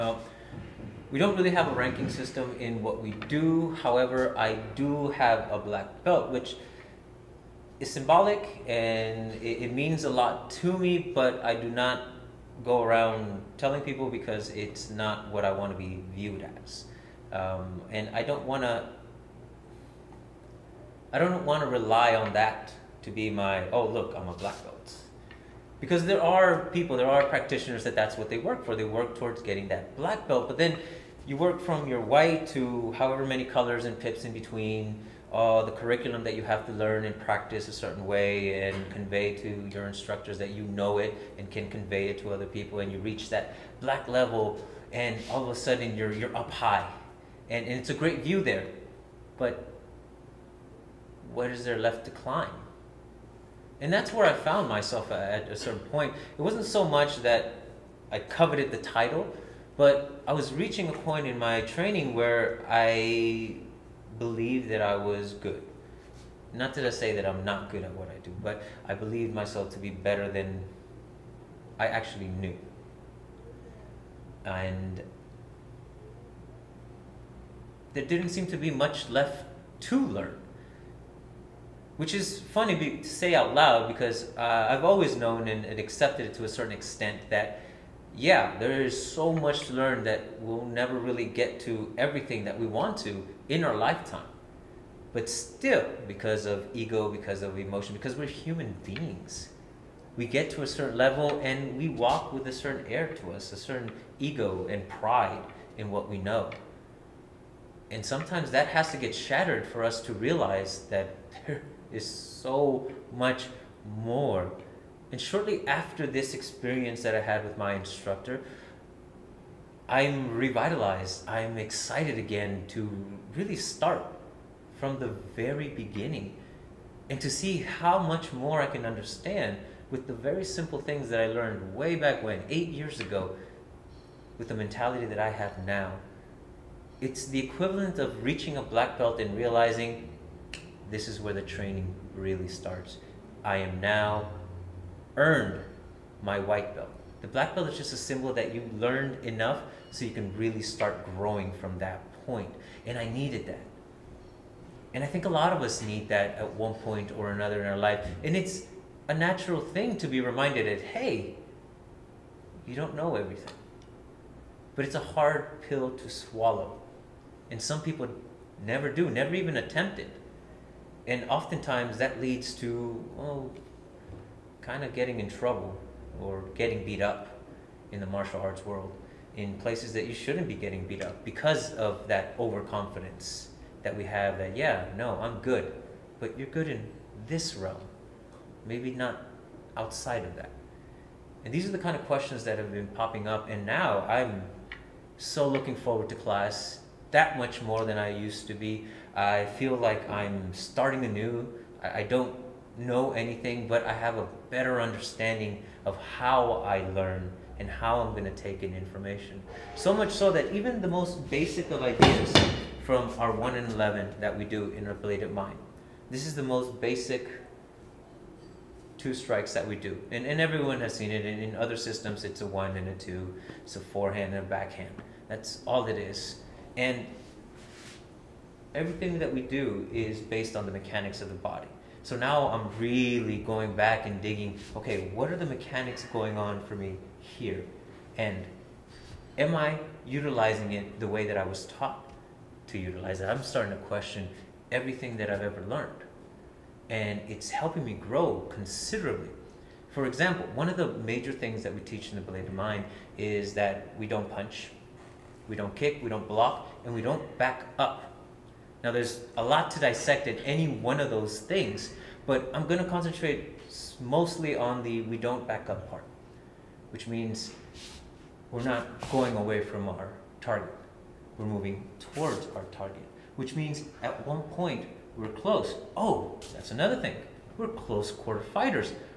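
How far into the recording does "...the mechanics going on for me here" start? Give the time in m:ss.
3:55.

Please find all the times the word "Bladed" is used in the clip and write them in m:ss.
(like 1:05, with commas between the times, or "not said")
3:35, 4:12.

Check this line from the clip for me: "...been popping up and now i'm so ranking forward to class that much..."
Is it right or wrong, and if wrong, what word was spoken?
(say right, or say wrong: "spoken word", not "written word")
wrong: "looking", not "ranking".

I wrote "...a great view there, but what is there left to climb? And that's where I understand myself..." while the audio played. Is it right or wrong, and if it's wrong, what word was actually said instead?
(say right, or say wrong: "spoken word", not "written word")
wrong: "found", not "understand".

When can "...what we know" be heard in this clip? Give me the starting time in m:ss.
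1:45.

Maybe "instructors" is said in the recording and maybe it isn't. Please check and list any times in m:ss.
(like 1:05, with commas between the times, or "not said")
0:39, 1:57.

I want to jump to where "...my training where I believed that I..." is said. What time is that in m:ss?
1:01.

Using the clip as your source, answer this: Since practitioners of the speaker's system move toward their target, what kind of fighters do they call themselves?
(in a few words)
Close quarter fighters.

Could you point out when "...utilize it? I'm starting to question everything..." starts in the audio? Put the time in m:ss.
4:02.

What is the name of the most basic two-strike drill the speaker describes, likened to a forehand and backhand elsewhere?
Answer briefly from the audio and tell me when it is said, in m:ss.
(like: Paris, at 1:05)
1 and 11, at 3:33.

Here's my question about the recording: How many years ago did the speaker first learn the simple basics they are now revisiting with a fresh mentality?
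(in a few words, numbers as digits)
8.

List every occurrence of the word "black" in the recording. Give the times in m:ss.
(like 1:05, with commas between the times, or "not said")
0:05, 0:24, 0:29, 0:43, 2:18, 2:27.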